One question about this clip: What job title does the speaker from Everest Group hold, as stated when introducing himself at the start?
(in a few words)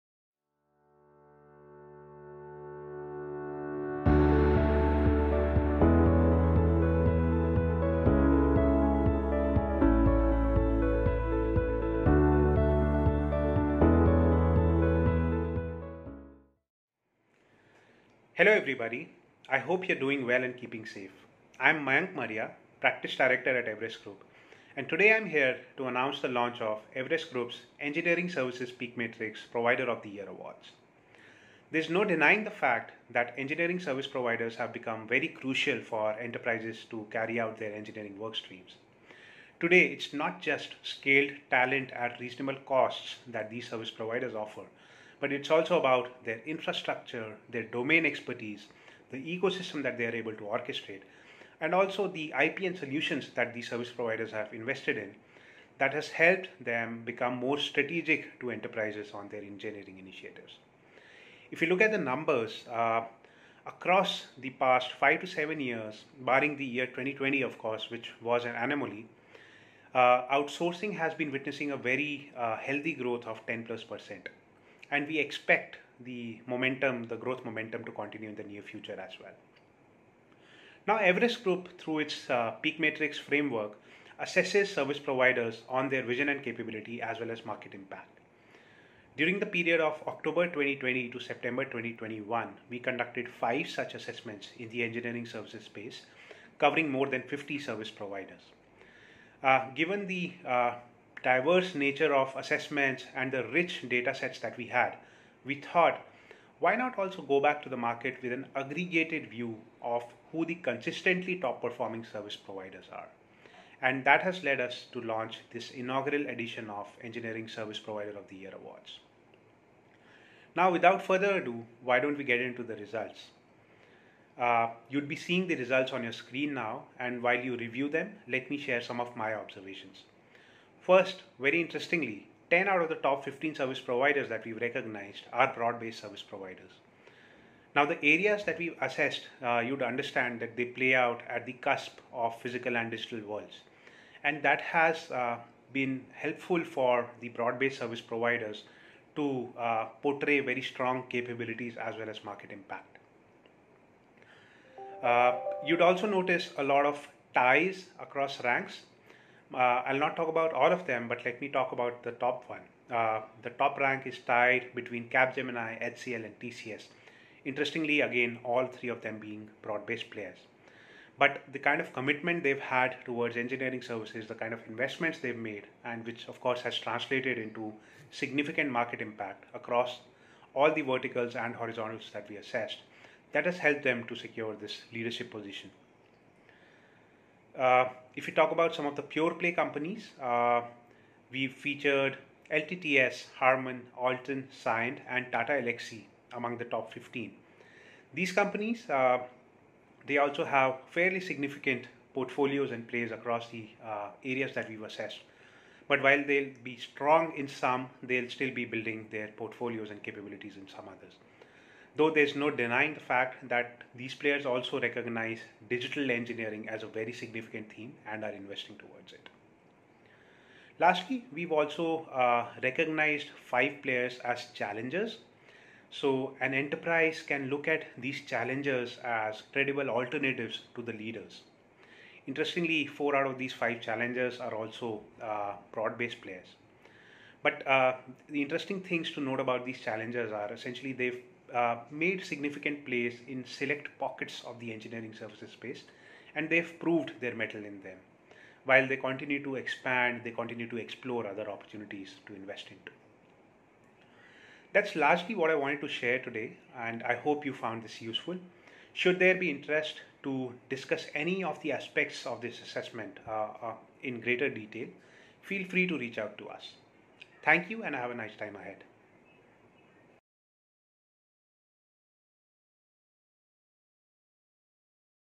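Practice Director.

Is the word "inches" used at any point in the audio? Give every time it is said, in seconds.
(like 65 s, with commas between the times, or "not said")
not said.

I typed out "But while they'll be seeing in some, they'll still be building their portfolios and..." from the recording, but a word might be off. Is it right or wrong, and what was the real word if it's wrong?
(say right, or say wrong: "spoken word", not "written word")
wrong: "strong", not "seeing".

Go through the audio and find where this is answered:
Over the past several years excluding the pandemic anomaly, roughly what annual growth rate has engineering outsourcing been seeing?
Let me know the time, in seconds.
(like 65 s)
73 s.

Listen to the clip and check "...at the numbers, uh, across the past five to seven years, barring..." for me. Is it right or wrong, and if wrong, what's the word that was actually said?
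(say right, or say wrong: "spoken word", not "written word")
right.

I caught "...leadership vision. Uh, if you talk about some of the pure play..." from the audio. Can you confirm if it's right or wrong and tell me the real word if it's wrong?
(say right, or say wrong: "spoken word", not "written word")
wrong: "position", not "vision".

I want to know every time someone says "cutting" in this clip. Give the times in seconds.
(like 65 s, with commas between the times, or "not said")
not said.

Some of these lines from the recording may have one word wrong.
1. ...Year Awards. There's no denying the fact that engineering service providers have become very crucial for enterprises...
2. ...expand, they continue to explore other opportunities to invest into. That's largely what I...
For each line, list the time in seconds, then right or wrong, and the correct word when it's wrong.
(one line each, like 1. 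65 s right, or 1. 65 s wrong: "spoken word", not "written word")
1. 30 s right
2. 249 s right.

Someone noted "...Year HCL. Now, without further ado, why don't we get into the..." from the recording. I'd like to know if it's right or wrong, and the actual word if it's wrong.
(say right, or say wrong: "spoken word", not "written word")
wrong: "Awards", not "HCL".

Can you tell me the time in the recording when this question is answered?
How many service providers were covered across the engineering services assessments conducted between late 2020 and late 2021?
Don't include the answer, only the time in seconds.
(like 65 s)
96 s.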